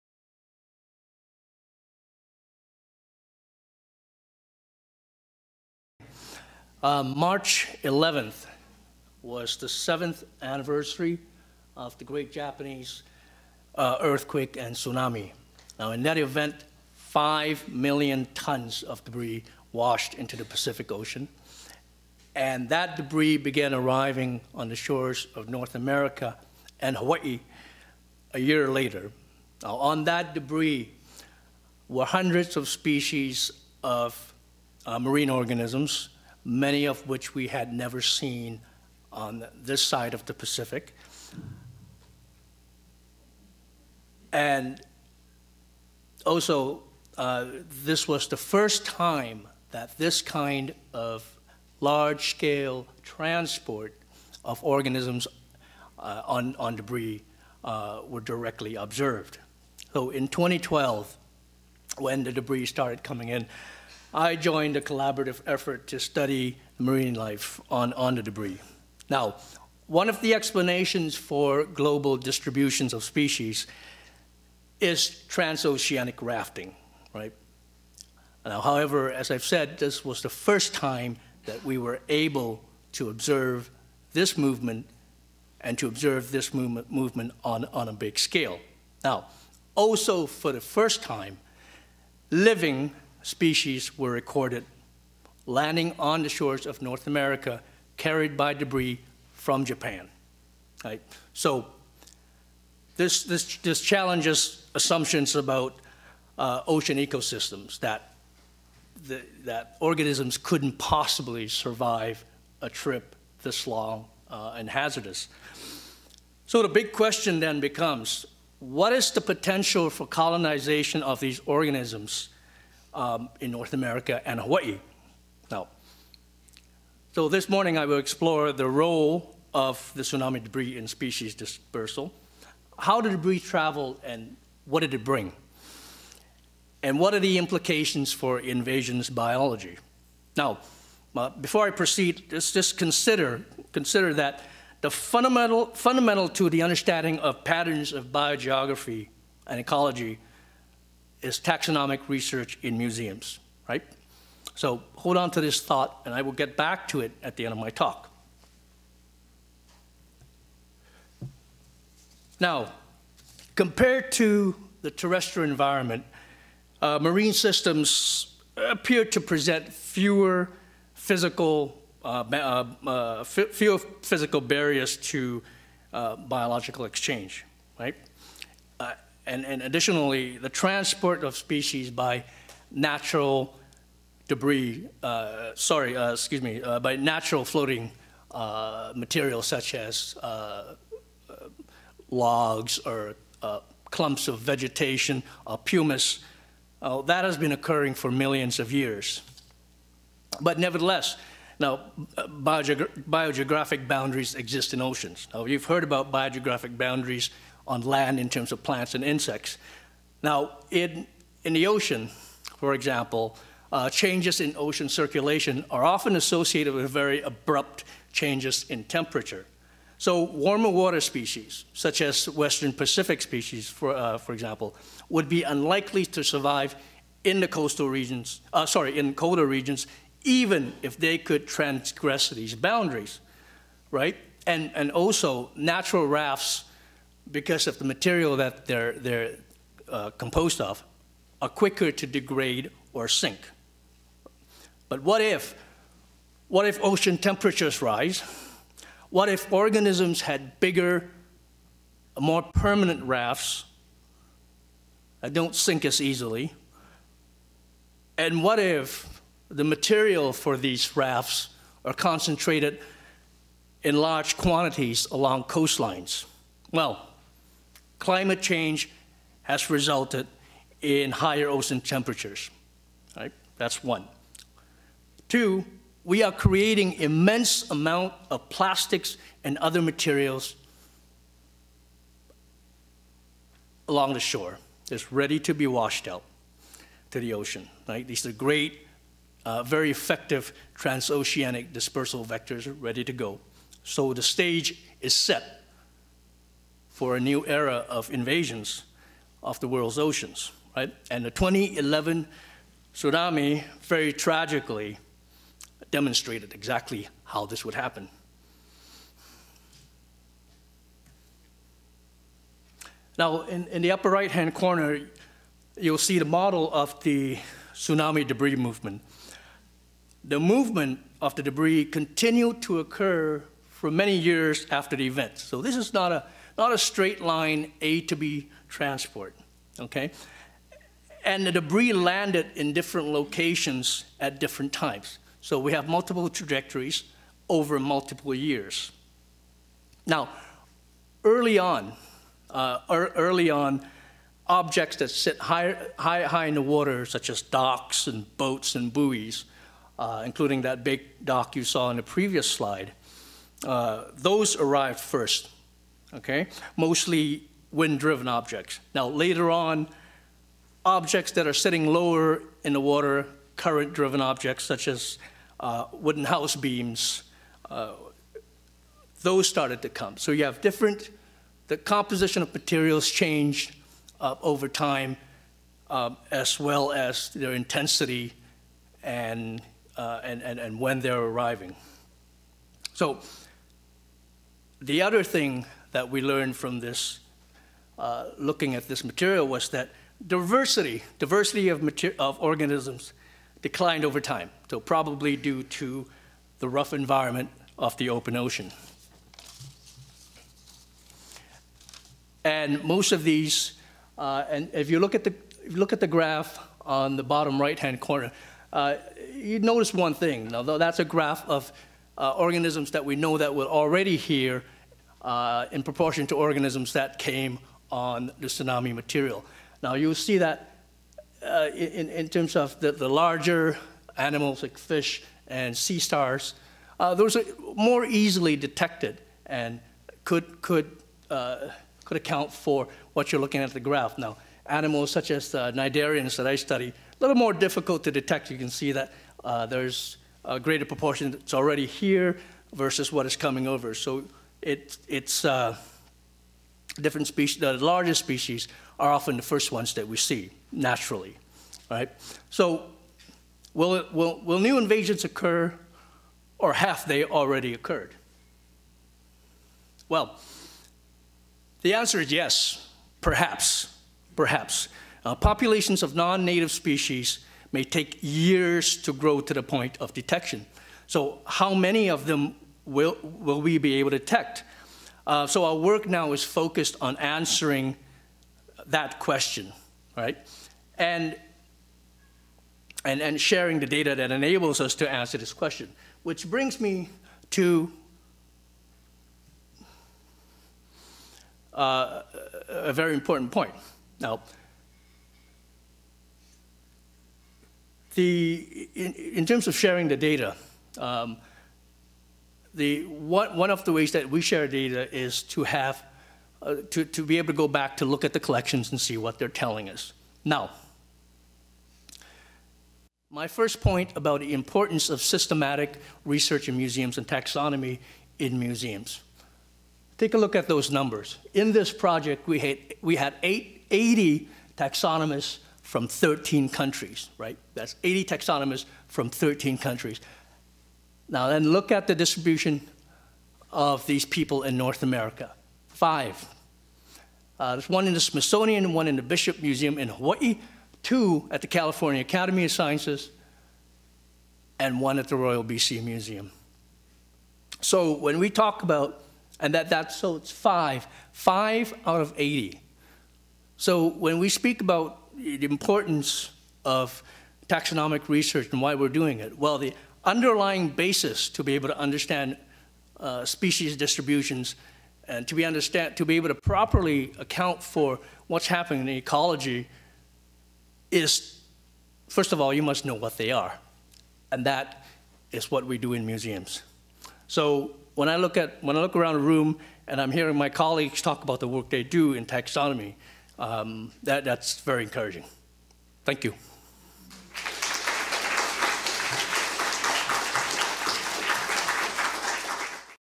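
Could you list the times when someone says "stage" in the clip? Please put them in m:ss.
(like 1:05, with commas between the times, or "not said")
4:54.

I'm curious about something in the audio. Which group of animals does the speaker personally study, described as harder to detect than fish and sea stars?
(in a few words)
cnidarians.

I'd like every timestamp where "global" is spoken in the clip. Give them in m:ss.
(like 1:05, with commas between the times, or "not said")
1:11.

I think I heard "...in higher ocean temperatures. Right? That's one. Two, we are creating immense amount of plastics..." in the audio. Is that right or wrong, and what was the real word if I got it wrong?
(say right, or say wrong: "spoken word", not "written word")
right.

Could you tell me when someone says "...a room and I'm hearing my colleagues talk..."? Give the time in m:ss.
9:39.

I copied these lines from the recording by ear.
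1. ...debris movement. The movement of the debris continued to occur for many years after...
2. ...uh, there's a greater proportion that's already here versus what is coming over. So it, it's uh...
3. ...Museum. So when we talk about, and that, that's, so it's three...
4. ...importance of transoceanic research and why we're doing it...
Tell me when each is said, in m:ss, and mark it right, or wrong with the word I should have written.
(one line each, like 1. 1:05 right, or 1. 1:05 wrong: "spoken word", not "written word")
1. 5:18 right
2. 7:19 right
3. 9:06 wrong: "five", not "three"
4. 9:15 wrong: "taxonomic", not "transoceanic".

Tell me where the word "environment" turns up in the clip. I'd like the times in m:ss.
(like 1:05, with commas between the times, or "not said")
2:45, 6:36.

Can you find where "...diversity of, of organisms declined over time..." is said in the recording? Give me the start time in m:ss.
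6:31.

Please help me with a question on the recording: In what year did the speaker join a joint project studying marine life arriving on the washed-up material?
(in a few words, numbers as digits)
2012.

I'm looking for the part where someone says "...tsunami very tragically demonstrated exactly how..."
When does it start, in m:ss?
5:02.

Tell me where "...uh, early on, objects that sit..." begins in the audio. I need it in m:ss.
5:42.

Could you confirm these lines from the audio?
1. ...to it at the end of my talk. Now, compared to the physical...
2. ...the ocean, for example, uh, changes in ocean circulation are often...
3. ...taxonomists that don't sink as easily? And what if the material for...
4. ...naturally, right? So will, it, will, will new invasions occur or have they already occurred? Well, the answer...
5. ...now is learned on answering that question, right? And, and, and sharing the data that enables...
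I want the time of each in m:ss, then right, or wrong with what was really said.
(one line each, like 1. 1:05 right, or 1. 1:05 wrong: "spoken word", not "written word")
1. 2:36 wrong: "terrestrial", not "physical"
2. 3:31 right
3. 4:13 wrong: "rafts", not "taxonomists"
4. 7:30 right
5. 7:56 wrong: "focused", not "learned".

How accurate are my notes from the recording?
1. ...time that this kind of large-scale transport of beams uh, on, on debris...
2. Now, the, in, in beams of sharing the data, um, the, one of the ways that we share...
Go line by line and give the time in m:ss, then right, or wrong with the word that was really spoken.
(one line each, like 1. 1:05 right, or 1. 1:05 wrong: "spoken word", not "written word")
1. 0:48 wrong: "organisms", not "beams"
2. 8:14 wrong: "terms", not "beams".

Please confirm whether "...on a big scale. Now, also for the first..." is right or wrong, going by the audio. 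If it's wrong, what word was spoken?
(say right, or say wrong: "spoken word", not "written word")
right.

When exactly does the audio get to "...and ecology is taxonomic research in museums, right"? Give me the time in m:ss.
2:29.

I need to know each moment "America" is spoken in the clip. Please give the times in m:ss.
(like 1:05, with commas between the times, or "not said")
0:25, 1:37, 2:03, 8:55.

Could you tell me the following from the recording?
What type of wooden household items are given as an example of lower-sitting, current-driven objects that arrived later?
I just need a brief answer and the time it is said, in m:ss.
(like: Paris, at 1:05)
wooden house beams, at 6:05.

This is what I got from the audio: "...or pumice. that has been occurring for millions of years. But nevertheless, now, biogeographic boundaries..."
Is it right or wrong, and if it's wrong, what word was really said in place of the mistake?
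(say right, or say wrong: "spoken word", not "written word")
right.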